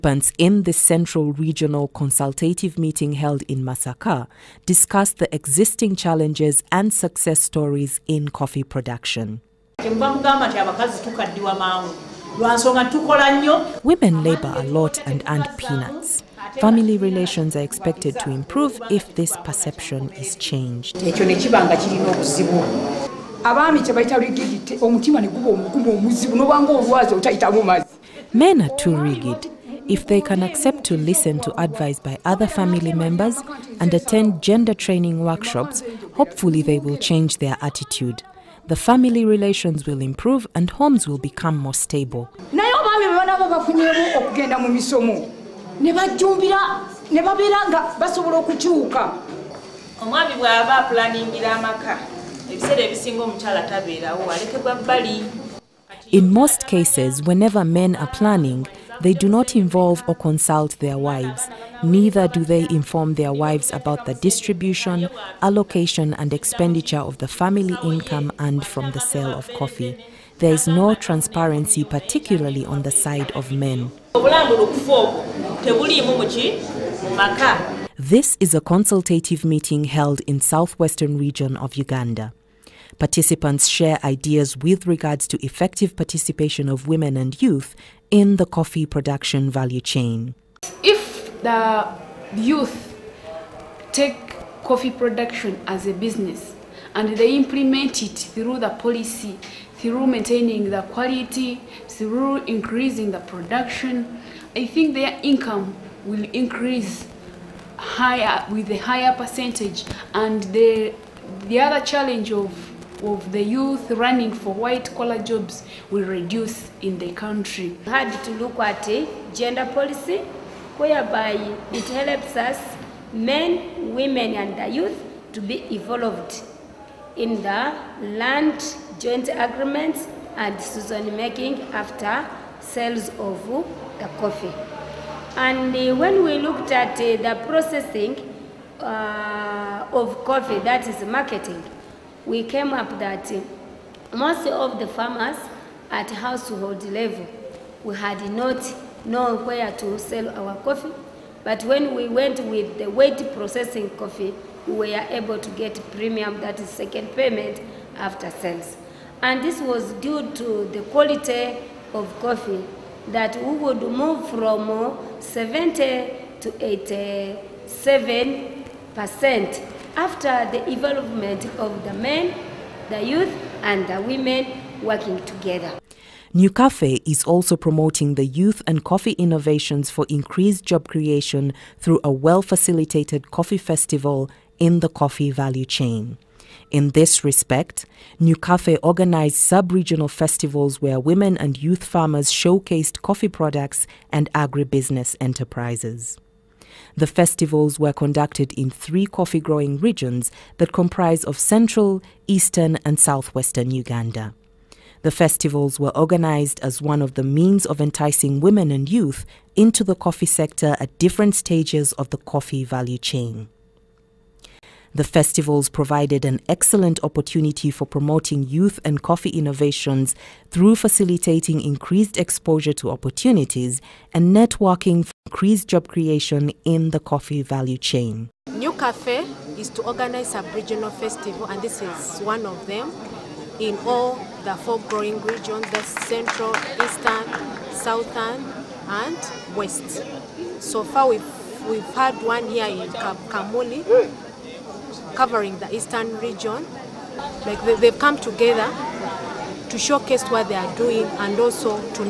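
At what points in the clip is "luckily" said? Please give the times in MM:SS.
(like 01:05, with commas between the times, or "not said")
not said.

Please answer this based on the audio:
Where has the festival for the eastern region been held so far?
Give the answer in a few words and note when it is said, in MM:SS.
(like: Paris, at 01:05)
Kamuli, at 04:02.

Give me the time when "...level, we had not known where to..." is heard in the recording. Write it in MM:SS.
02:26.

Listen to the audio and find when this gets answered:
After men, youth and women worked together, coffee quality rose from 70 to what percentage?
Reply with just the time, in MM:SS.
02:46.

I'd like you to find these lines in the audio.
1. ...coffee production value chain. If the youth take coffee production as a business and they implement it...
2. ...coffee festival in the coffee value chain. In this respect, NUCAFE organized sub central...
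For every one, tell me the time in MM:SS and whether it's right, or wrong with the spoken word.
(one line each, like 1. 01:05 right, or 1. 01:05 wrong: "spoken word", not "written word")
1. 01:28 right
2. 03:03 wrong: "regional", not "central".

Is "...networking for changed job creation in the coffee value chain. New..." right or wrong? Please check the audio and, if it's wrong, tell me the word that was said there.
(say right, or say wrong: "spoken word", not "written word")
wrong: "increased", not "changed".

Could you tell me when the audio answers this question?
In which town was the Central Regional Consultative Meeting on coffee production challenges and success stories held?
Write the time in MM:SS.
00:03.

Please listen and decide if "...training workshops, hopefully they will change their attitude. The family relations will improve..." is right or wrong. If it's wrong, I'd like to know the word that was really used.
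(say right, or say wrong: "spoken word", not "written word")
right.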